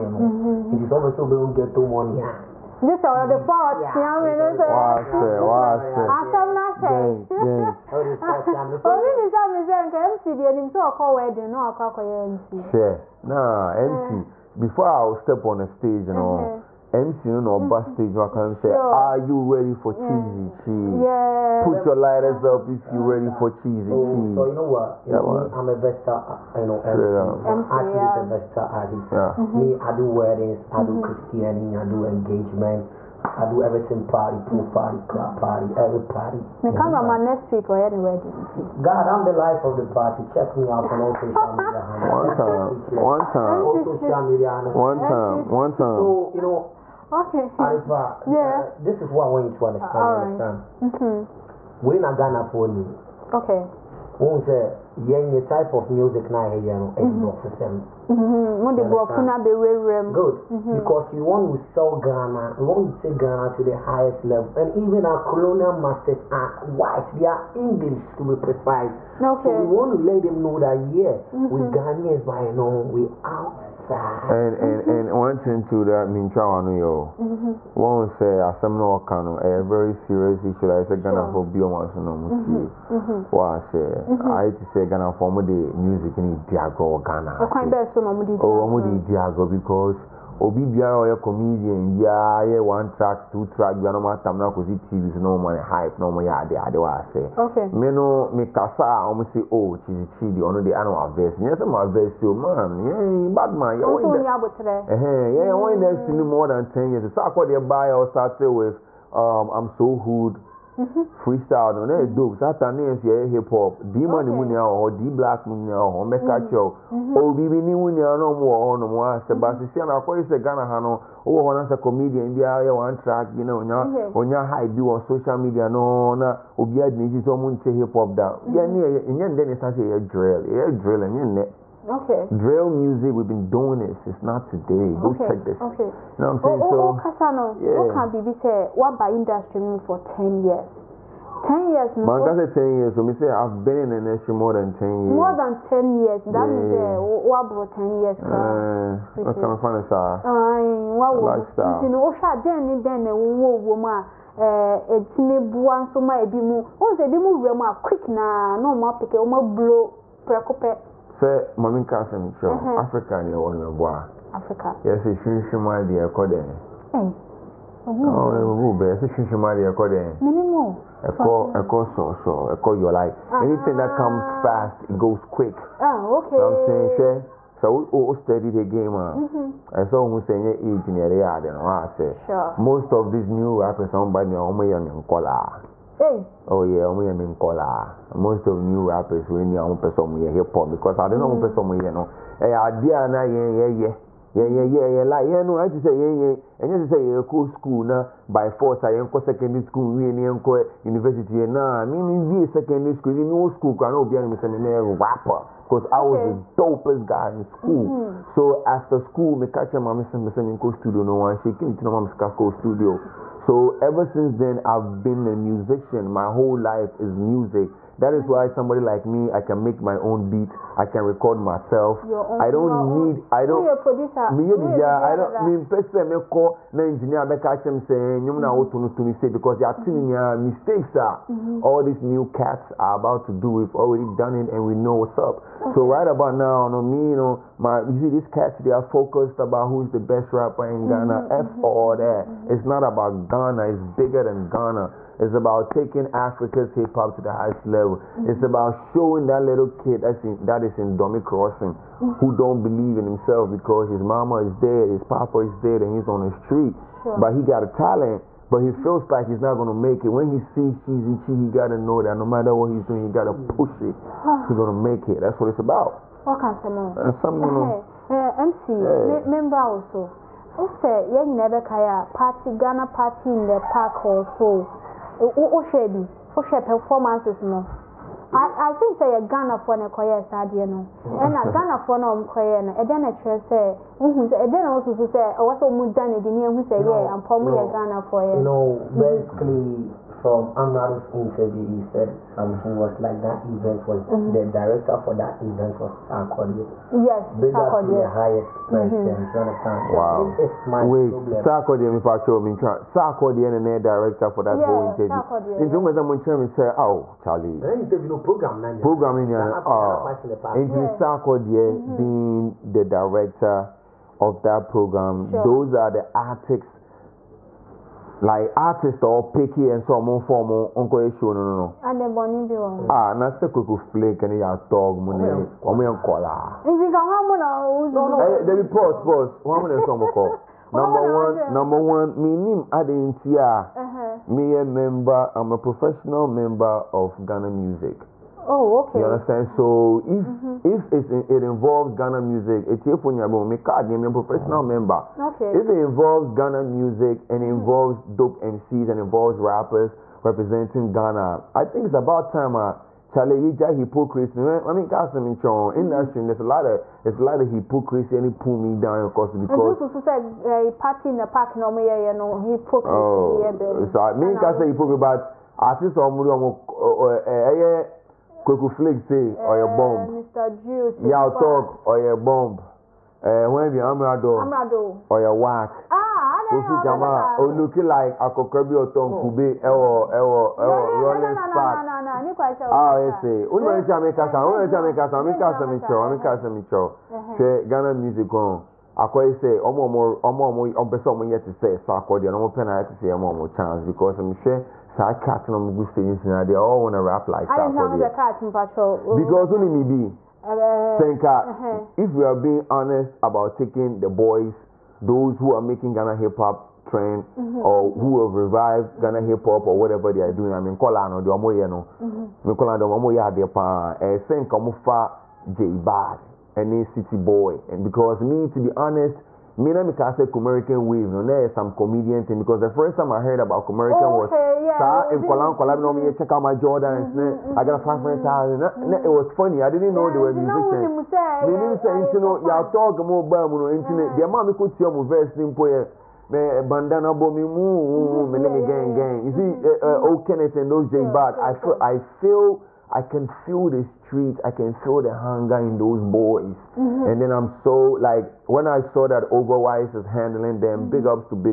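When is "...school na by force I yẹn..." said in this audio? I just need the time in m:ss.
3:17.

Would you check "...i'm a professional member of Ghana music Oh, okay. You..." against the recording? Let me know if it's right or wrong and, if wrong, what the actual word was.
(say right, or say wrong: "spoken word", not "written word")
right.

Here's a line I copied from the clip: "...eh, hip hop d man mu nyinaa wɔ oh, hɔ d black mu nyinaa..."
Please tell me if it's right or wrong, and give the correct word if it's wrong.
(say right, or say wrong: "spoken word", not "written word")
right.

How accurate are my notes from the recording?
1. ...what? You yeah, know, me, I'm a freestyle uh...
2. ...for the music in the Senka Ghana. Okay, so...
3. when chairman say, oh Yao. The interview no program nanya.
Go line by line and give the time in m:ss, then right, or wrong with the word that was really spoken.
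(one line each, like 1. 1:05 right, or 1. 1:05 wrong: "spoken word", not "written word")
1. 0:24 wrong: "versatile", not "freestyle"
2. 1:25 wrong: "Diagro", not "Senka"
3. 5:06 wrong: "Charlie", not "Yao".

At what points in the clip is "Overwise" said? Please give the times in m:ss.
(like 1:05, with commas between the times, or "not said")
7:29.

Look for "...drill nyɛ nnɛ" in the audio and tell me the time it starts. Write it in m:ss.
2:10.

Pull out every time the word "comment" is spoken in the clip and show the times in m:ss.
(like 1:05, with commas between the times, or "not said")
not said.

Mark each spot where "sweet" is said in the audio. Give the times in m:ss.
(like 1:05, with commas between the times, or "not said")
not said.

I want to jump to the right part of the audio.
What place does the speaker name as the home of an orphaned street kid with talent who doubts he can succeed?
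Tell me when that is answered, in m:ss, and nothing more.
4:10.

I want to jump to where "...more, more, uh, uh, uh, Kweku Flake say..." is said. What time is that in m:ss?
6:06.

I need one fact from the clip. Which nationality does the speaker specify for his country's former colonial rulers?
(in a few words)
English.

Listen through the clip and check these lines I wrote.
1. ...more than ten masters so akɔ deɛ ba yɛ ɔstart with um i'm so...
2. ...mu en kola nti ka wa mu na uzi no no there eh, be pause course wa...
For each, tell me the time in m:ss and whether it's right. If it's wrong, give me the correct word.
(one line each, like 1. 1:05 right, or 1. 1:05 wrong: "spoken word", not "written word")
1. 1:46 wrong: "years", not "masters"
2. 5:25 wrong: "pause", not "course".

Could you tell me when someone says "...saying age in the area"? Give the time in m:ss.
3:00.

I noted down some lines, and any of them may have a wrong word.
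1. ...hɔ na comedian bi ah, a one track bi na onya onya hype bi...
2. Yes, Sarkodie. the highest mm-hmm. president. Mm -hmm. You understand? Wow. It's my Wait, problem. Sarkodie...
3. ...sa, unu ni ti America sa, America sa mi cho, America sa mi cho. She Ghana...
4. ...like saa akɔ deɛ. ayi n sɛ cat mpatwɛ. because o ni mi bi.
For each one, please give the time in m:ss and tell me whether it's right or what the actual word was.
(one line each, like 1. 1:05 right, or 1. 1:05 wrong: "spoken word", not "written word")
1. 2:01 right
2. 4:57 right
3. 6:24 right
4. 6:37 right.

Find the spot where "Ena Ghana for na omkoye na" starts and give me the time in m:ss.
4:41.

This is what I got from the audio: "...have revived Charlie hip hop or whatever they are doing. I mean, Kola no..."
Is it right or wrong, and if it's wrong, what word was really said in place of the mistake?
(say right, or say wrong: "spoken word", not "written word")
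wrong: "Ghana", not "Charlie".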